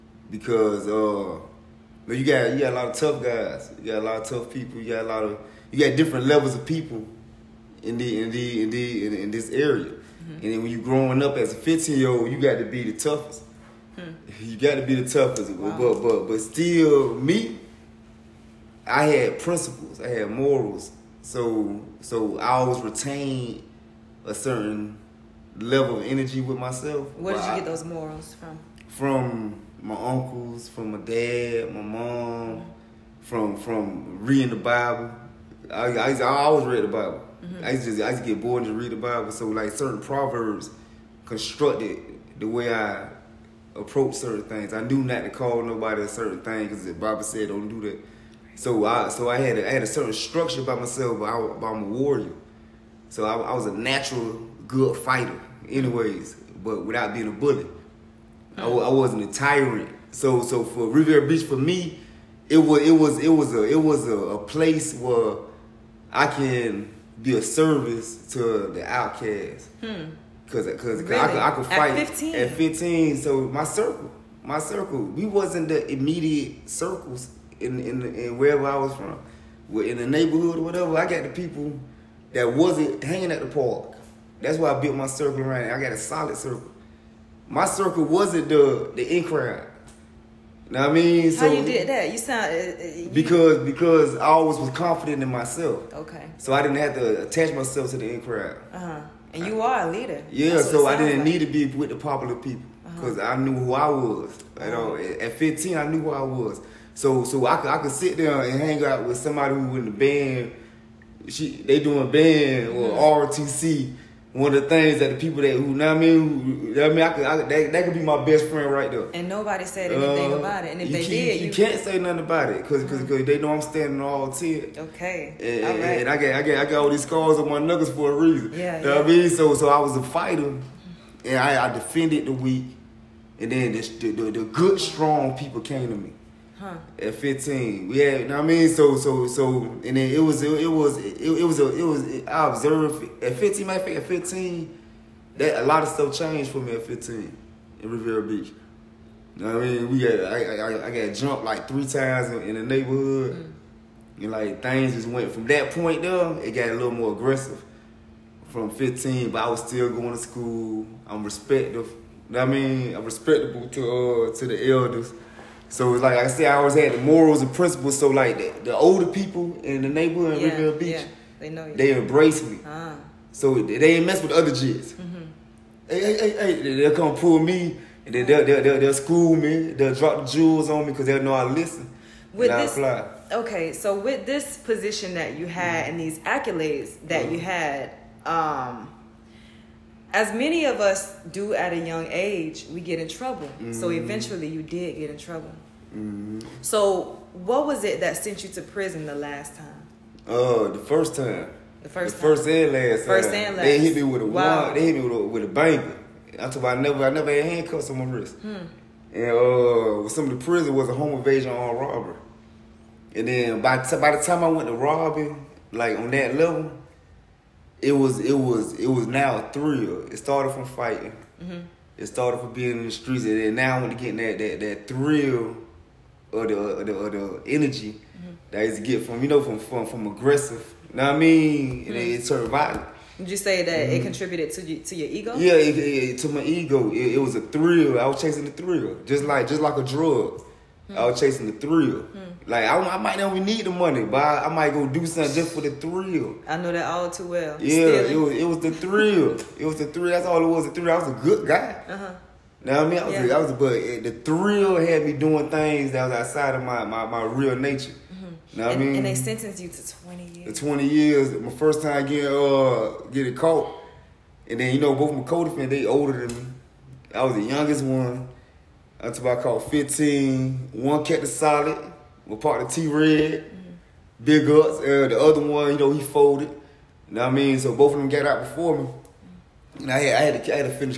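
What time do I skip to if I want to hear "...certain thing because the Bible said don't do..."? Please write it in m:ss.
0:46.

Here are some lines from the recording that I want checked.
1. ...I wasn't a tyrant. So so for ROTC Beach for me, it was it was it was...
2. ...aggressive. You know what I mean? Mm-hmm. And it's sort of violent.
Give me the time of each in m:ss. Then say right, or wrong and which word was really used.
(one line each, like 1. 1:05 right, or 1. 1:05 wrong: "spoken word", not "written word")
1. 0:58 wrong: "Riviera", not "ROTC"
2. 3:50 right.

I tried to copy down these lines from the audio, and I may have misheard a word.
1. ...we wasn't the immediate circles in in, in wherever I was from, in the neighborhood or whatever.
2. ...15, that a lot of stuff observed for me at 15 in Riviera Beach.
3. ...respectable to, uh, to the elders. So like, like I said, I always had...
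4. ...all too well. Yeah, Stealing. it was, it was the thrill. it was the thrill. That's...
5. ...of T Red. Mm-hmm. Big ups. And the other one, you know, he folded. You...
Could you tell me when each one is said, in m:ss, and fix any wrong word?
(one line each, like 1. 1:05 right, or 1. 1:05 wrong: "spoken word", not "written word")
1. 1:15 right
2. 2:24 wrong: "changed", not "observed"
3. 2:43 right
4. 4:06 right
5. 4:32 right.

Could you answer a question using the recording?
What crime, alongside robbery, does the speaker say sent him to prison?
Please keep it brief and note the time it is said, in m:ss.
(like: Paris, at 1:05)
Home invasion, at 3:30.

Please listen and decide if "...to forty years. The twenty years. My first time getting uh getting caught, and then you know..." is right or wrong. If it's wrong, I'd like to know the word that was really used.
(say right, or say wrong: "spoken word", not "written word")
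wrong: "twenty", not "forty".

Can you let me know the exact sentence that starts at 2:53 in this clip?
So they ain't mess with other jits.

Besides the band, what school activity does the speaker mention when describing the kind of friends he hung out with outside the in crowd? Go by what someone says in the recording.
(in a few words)
ROTC.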